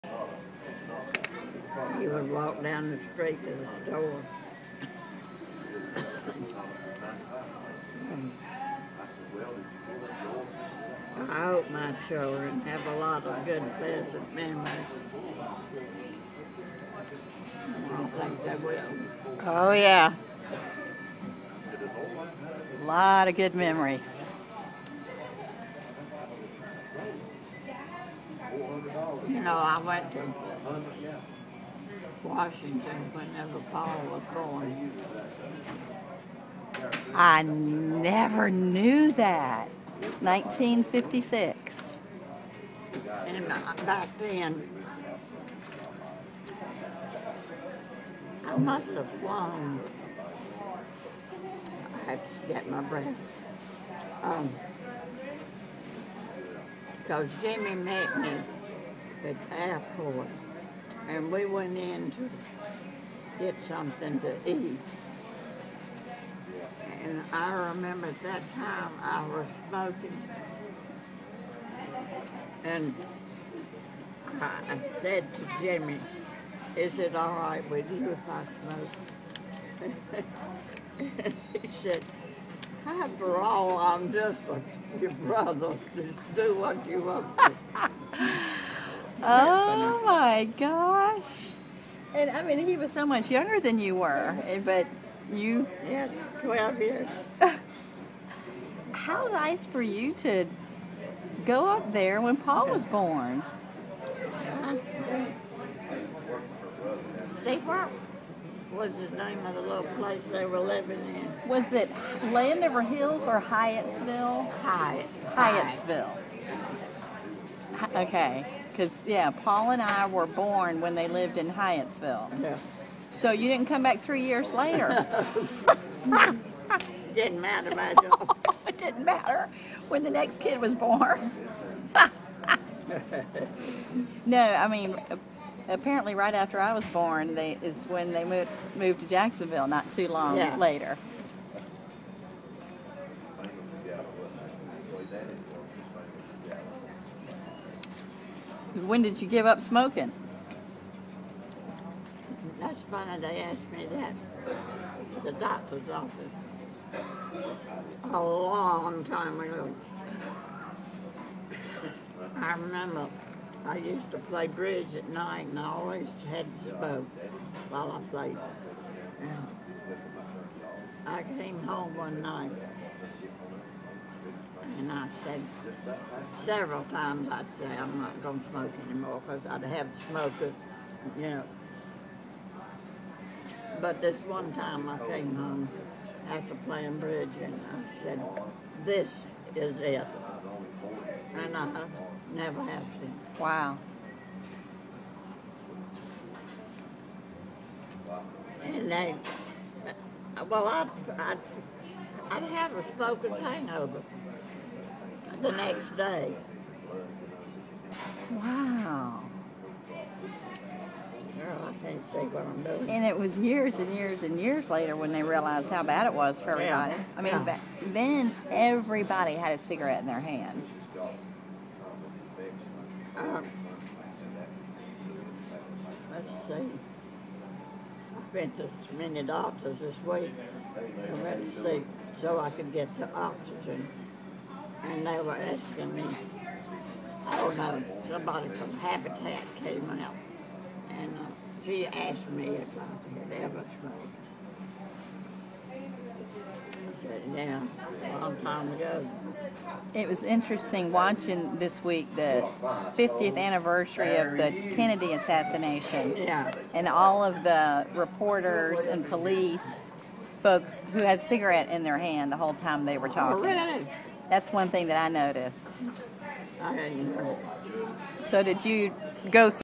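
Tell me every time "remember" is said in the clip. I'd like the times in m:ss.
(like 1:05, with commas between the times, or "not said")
1:07, 2:42.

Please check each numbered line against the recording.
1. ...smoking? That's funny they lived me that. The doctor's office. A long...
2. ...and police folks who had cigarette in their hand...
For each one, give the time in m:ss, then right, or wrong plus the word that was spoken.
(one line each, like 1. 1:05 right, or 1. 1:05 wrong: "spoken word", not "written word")
1. 2:29 wrong: "asked", not "lived"
2. 4:18 right.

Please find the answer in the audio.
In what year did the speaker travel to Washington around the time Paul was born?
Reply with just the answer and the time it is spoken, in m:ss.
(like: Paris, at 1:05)
1956, at 0:40.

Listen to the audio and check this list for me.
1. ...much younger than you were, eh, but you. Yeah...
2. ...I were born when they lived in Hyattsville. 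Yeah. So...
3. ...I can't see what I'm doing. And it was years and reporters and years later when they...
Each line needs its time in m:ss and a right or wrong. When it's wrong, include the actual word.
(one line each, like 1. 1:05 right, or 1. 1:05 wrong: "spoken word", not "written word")
1. 1:33 right
2. 1:59 right
3. 3:31 wrong: "years", not "reporters".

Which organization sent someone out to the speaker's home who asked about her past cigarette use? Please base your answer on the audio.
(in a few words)
Habitat.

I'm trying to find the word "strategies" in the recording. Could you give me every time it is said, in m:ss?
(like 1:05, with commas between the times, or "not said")
not said.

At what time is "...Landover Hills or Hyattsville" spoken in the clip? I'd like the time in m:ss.
1:52.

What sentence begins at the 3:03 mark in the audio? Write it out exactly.
But this one time I came home after playing bridge and I said, this is it.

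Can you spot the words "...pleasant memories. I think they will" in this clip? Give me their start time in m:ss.
0:13.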